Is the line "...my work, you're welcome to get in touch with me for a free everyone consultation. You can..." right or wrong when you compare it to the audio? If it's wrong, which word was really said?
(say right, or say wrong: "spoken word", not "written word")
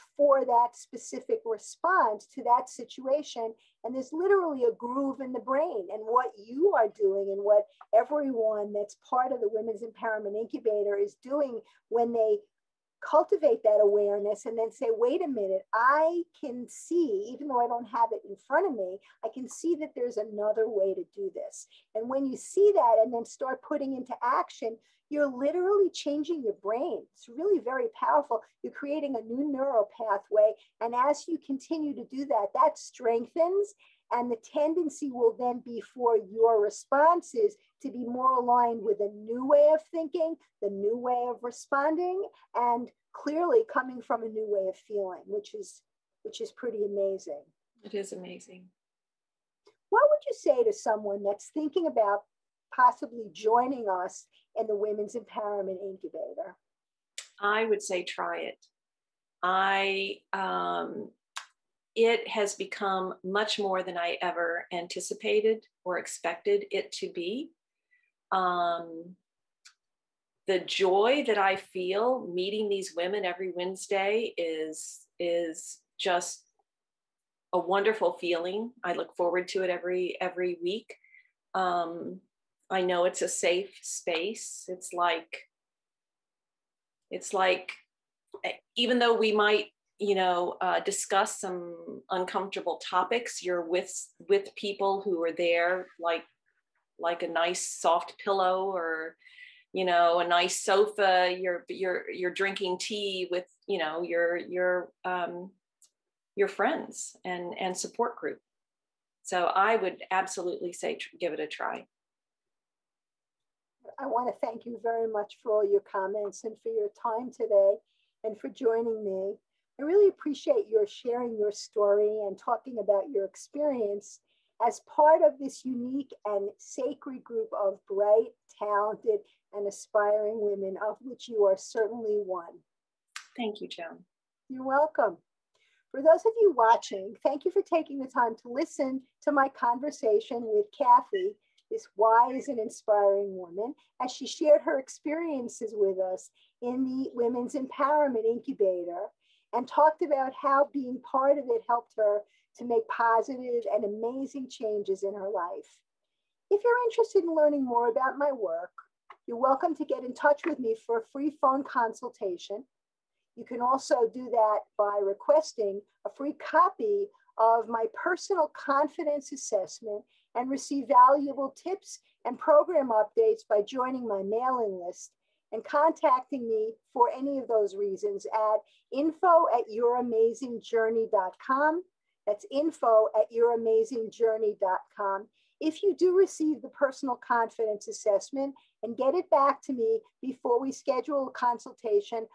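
wrong: "phone", not "everyone".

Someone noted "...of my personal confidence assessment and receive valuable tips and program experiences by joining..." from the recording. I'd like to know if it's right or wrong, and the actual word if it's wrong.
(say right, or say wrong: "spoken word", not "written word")
wrong: "updates", not "experiences".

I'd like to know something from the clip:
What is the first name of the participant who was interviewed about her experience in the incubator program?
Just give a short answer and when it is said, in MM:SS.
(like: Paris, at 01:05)
Kathy, at 02:20.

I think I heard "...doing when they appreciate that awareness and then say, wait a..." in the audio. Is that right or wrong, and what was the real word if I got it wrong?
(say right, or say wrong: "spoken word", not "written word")
wrong: "cultivate", not "appreciate".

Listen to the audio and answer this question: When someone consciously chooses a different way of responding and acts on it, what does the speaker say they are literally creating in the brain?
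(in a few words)
A new neural pathway.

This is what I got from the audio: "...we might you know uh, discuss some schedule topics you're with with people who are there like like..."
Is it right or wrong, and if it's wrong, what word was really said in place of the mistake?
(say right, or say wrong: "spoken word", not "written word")
wrong: "uncomfortable", not "schedule".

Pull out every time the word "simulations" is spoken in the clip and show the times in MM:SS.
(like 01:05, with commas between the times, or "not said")
not said.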